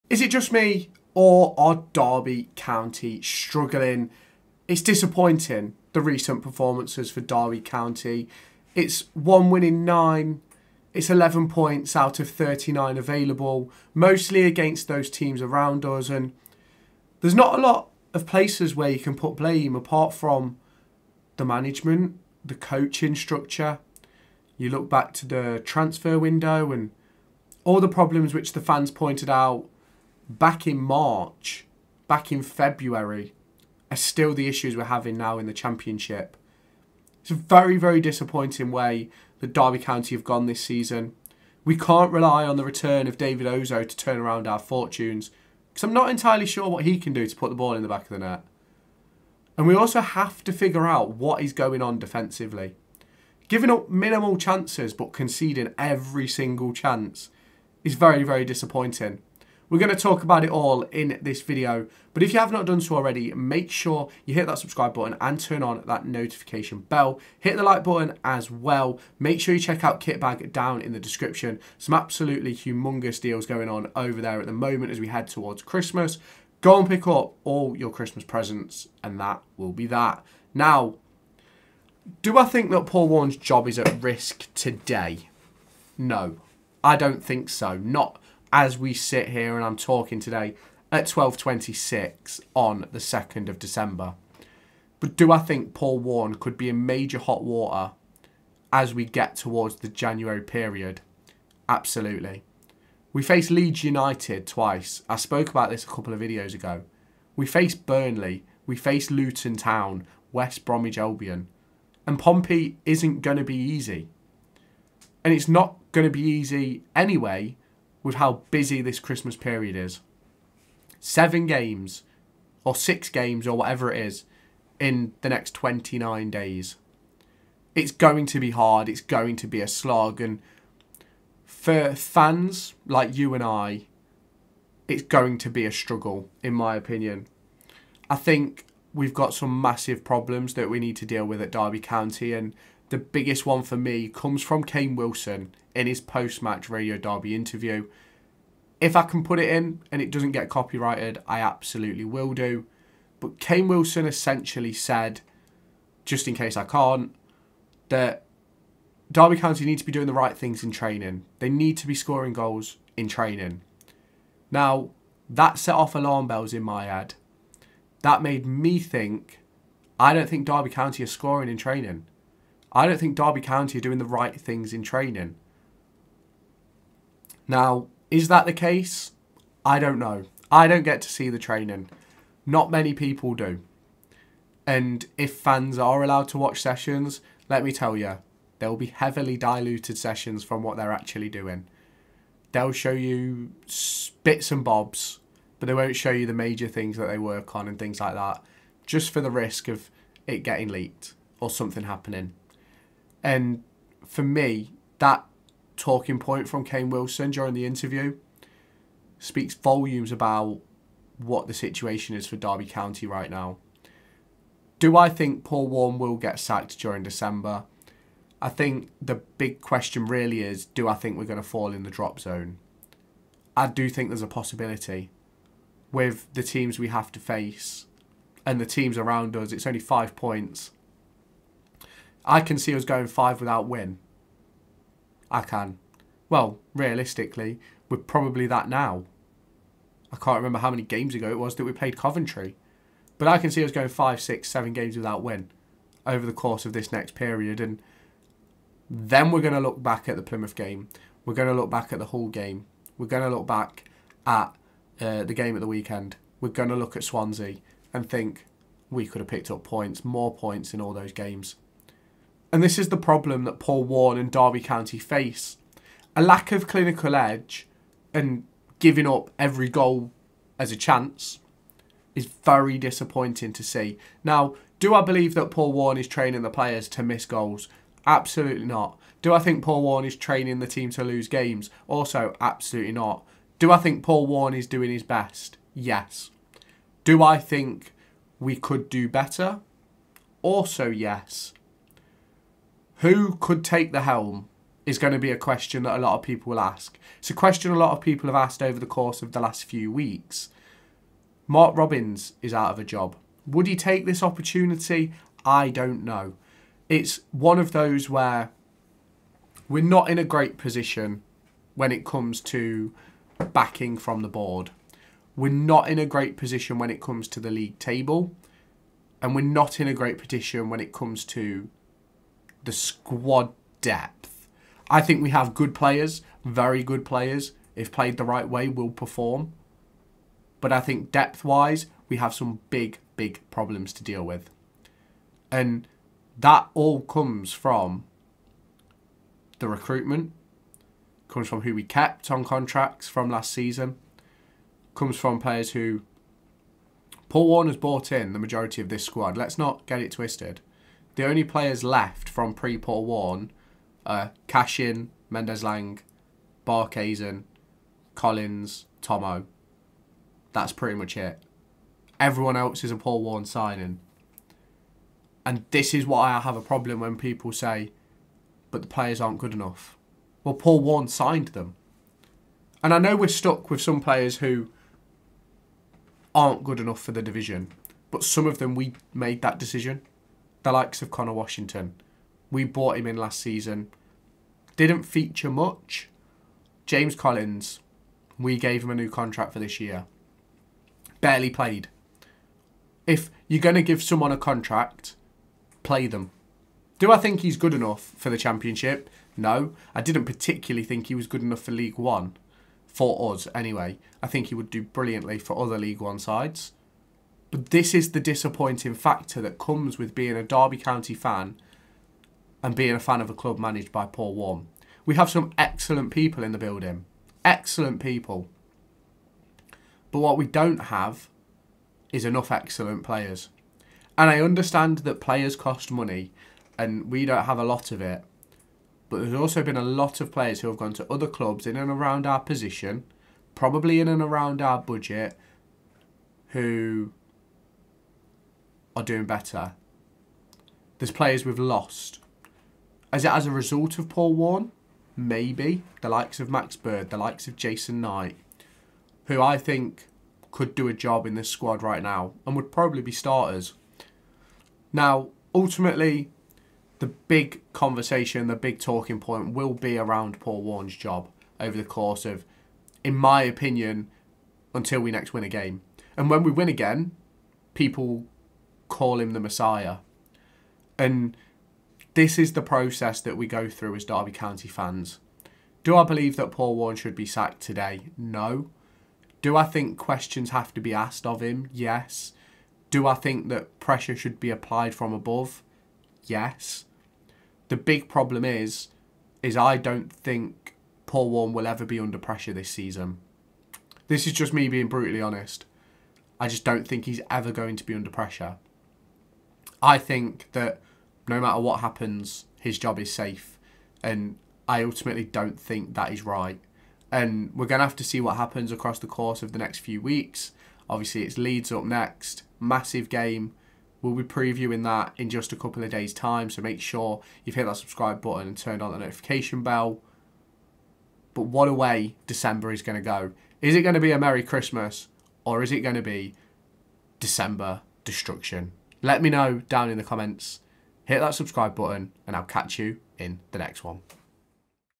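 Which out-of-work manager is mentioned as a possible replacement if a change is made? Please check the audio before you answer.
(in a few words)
Mark Robins.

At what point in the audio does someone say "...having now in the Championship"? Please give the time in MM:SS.
00:34.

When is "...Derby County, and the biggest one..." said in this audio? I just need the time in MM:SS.
02:21.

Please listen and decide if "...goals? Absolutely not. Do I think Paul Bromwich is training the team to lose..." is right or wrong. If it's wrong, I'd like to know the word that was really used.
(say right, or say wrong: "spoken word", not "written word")
wrong: "Warne", not "Bromwich".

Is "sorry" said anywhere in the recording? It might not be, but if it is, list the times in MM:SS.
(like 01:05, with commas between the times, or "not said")
not said.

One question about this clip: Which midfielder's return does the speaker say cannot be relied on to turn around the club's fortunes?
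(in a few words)
David Ozoh.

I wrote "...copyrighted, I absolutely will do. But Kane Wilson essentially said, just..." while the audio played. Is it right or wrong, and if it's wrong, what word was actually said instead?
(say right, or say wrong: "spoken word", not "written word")
right.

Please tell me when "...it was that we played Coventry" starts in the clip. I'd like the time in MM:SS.
04:01.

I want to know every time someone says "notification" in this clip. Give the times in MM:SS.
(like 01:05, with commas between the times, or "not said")
01:06, 08:38.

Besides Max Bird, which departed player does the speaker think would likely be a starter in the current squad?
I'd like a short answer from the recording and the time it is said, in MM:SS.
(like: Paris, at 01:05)
Jason Knight, at 07:27.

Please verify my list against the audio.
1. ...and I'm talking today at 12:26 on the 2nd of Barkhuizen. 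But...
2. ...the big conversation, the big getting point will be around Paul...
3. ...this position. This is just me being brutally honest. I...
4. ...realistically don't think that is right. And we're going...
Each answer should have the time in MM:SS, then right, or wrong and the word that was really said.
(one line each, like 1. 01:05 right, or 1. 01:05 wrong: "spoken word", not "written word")
1. 01:29 wrong: "December", not "Barkhuizen"
2. 07:36 wrong: "talking", not "getting"
3. 08:12 wrong: "season", not "position"
4. 08:24 wrong: "ultimately", not "realistically".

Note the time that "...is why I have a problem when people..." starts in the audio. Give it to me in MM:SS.
06:05.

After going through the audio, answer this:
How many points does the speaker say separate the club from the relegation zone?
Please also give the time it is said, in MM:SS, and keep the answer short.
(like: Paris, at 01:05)
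5, at 03:49.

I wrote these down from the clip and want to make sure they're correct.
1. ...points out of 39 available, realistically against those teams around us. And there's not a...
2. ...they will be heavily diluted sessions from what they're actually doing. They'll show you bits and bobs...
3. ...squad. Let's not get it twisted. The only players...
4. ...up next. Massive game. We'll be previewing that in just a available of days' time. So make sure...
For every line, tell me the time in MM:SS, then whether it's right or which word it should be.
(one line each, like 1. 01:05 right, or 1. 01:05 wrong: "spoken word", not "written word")
1. 00:11 wrong: "mostly", not "realistically"
2. 03:08 right
3. 05:49 right
4. 08:31 wrong: "couple", not "available".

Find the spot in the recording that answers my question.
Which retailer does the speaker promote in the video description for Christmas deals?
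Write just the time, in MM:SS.
01:10.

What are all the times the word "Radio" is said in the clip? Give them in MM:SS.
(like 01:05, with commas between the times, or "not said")
02:26.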